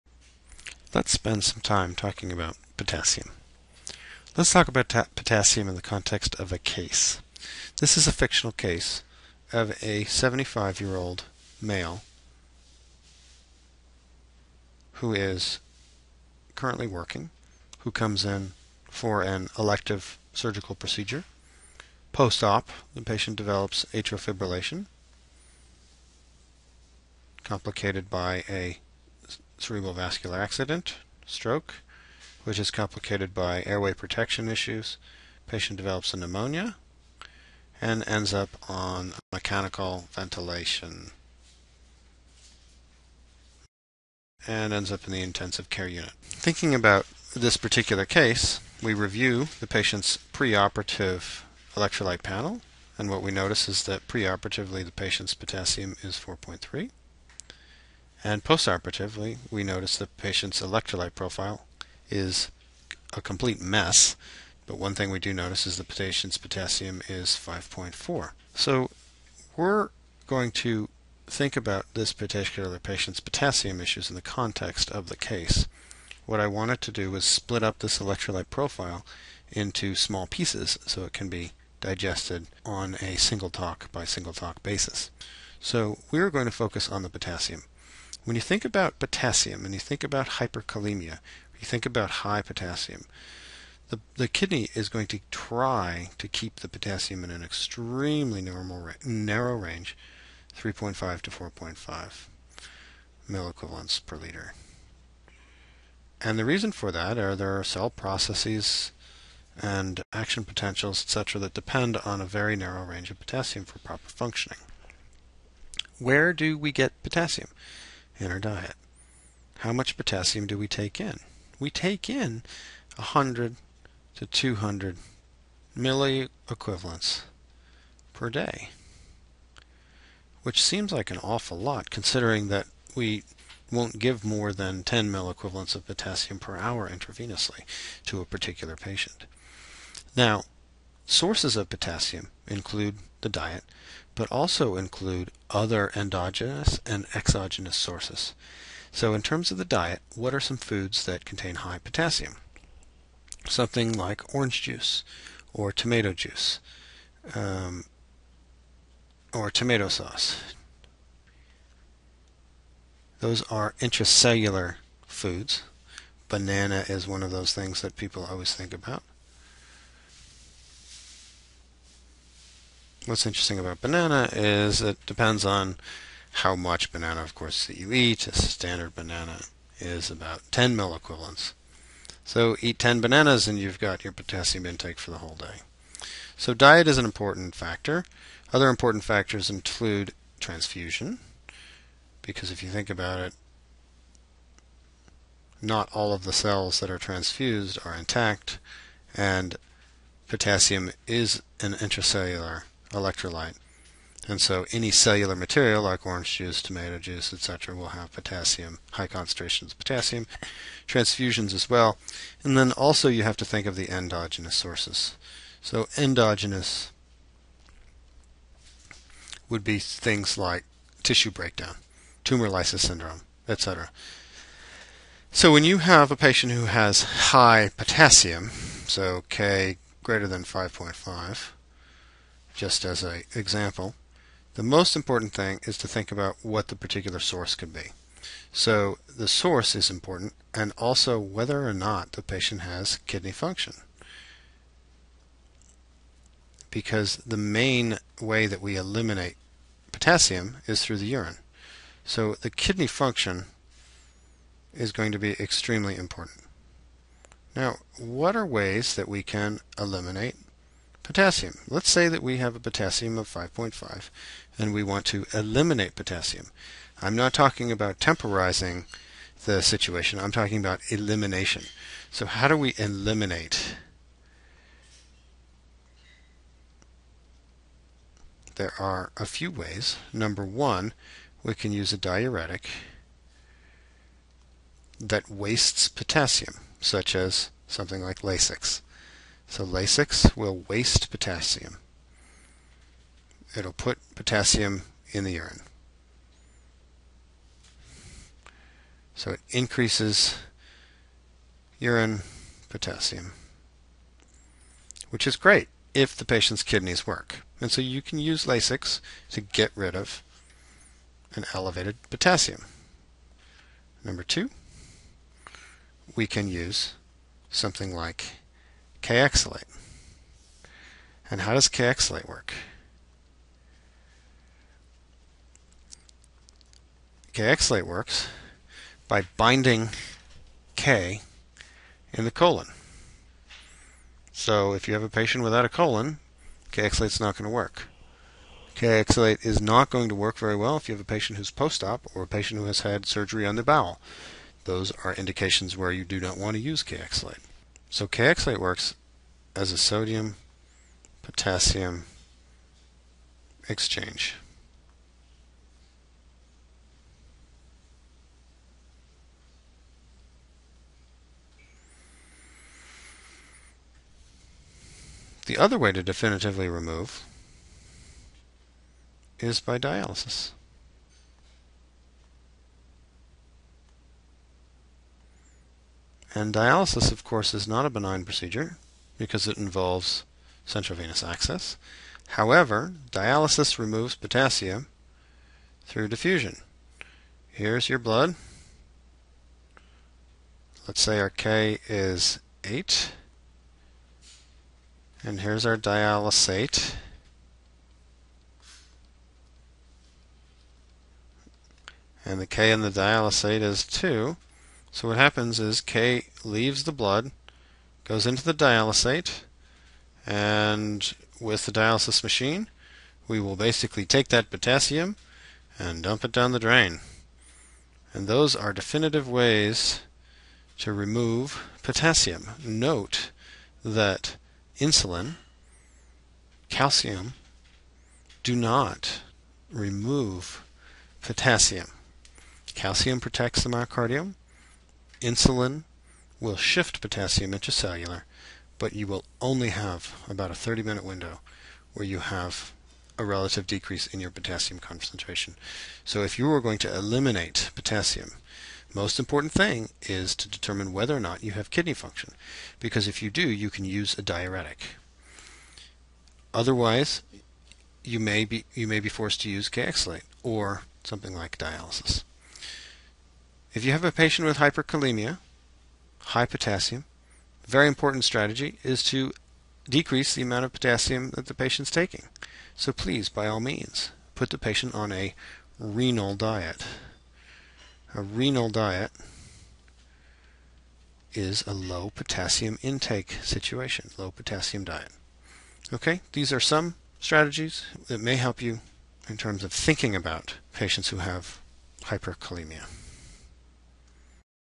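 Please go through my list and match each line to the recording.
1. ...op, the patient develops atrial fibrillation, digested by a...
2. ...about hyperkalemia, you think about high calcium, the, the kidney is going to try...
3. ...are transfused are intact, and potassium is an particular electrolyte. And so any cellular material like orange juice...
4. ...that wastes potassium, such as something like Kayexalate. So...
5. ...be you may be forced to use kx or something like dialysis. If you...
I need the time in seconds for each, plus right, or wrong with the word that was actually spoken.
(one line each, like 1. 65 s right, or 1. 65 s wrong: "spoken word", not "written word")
1. 22 s wrong: "complicated", not "digested"
2. 90 s wrong: "potassium", not "calcium"
3. 196 s wrong: "intracellular", not "particular"
4. 284 s wrong: "Lasix", not "Kayexalate"
5. 458 s right.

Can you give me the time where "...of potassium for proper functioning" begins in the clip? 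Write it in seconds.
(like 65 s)
113 s.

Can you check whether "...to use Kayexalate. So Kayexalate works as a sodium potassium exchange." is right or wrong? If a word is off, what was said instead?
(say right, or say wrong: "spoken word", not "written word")
right.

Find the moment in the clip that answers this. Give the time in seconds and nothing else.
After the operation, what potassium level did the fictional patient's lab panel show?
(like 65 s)
67 s.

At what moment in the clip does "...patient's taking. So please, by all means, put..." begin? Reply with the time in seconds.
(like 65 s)
471 s.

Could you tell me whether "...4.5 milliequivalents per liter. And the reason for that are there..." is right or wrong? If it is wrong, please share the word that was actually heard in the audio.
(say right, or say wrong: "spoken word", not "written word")
right.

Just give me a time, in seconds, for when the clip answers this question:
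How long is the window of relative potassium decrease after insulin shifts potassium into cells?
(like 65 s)
440 s.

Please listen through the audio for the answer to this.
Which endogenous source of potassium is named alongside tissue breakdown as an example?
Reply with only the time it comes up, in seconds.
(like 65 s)
222 s.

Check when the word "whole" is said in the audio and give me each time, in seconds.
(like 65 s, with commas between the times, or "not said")
185 s.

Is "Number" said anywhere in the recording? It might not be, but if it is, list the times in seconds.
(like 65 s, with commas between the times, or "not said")
280 s, 314 s.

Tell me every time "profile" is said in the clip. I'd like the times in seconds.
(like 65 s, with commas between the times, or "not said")
61 s, 78 s.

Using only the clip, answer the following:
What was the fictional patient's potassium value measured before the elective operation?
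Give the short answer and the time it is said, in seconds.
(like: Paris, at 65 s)
4.3, at 56 s.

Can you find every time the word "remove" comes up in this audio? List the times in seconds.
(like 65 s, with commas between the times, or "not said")
366 s, 383 s, 420 s, 429 s.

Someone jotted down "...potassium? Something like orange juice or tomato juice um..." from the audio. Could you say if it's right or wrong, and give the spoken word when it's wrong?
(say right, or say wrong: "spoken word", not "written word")
right.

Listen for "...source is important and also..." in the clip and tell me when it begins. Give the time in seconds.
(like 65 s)
239 s.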